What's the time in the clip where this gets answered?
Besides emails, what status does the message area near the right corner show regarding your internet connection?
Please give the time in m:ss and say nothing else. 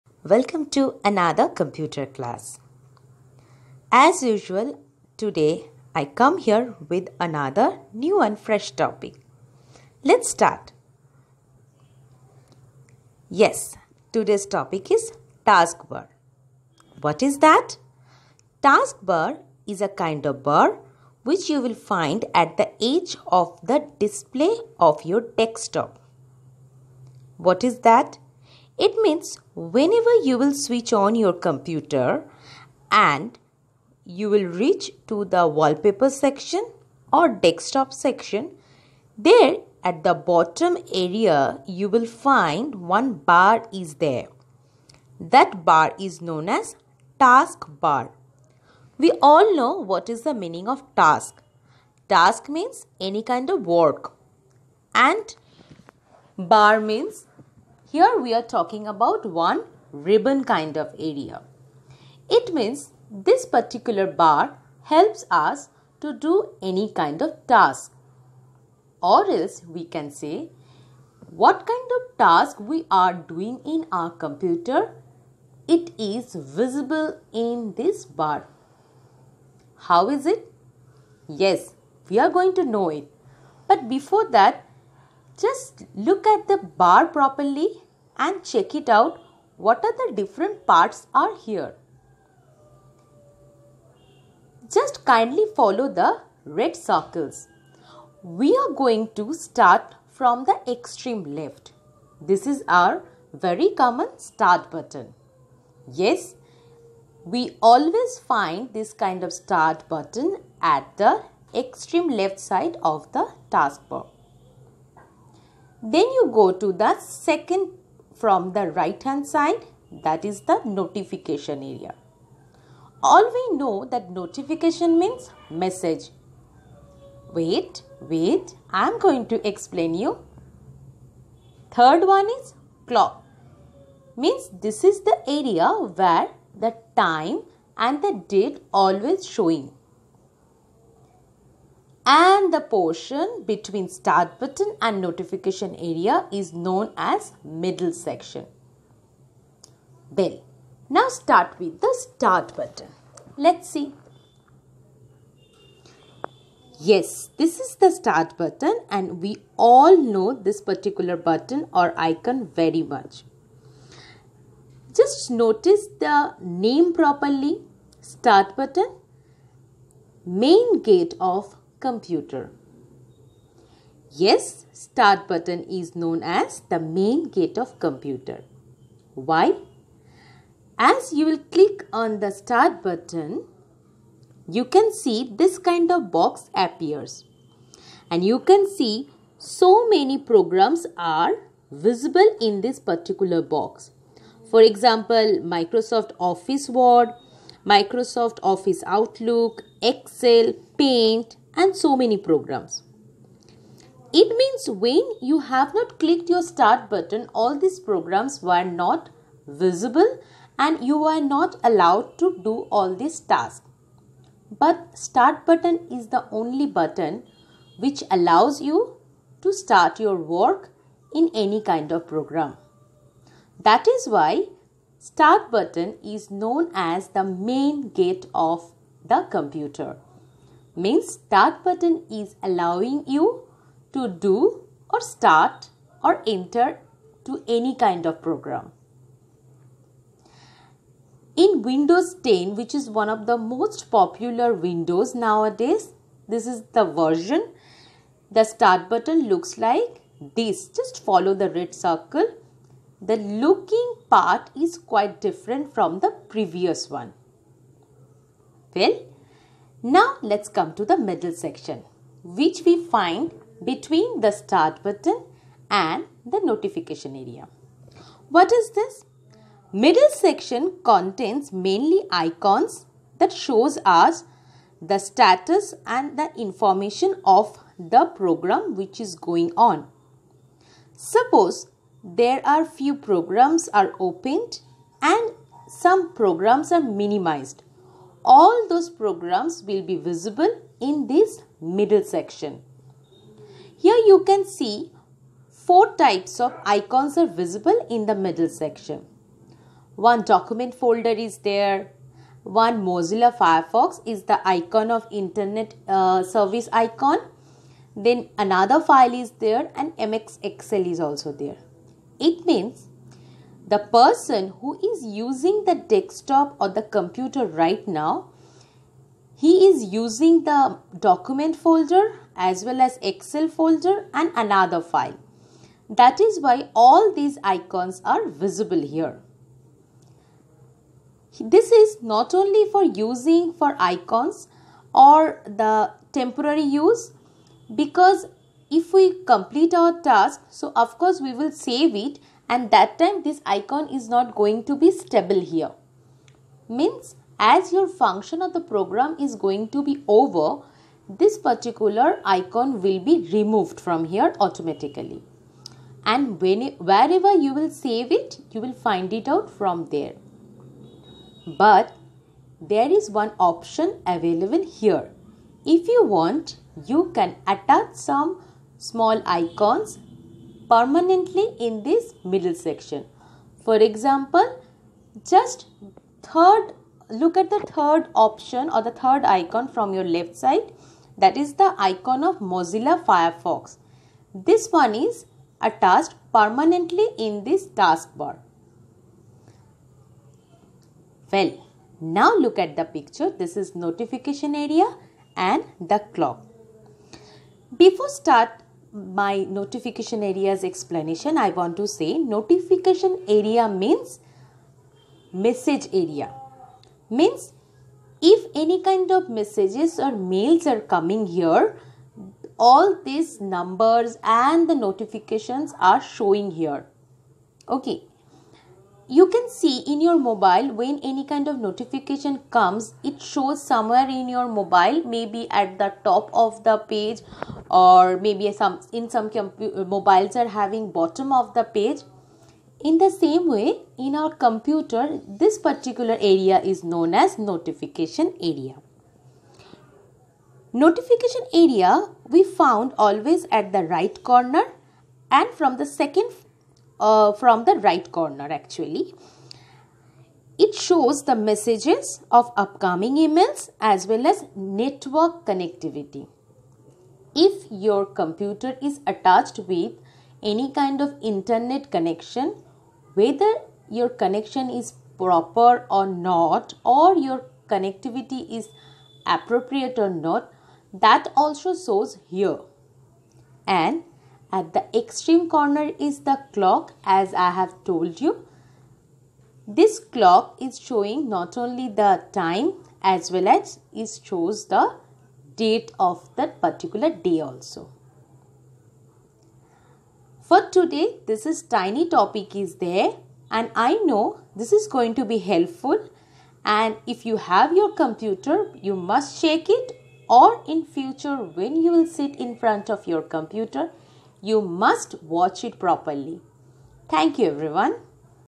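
7:34.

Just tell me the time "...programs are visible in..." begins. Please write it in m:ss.
3:10.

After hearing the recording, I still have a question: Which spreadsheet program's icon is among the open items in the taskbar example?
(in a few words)
MS Excel.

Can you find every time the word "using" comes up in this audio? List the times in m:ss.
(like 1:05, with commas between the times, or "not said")
5:15, 5:19, 5:33.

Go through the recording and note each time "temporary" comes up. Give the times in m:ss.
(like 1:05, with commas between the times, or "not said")
5:36.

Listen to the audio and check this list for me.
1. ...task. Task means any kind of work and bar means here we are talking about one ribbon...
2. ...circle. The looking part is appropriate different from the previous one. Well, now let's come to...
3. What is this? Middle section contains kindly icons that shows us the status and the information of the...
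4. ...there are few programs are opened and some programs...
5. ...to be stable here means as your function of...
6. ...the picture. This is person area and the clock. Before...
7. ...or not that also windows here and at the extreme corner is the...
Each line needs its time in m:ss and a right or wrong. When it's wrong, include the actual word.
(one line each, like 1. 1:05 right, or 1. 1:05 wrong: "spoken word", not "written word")
1. 0:50 right
2. 4:11 wrong: "quite", not "appropriate"
3. 4:28 wrong: "mainly", not "kindly"
4. 4:42 right
5. 5:44 right
6. 6:32 wrong: "notification", not "person"
7. 7:49 wrong: "shows", not "windows".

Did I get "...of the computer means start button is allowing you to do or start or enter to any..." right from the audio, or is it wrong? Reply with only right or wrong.
right.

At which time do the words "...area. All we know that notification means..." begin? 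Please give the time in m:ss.
2:01.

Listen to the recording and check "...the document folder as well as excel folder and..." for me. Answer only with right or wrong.
right.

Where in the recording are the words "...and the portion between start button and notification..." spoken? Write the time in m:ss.
2:22.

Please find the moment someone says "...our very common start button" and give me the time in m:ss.
1:42.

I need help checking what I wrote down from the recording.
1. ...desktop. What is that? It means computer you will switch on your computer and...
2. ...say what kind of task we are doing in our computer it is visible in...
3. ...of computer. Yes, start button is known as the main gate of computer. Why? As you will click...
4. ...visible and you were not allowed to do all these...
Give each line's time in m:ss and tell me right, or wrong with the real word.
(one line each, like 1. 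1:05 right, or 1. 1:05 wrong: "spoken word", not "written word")
1. 0:25 wrong: "whenever", not "computer"
2. 1:10 right
3. 2:51 right
4. 3:29 right.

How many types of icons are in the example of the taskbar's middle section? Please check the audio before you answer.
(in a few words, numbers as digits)
4.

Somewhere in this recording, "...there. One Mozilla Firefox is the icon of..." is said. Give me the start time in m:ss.
5:01.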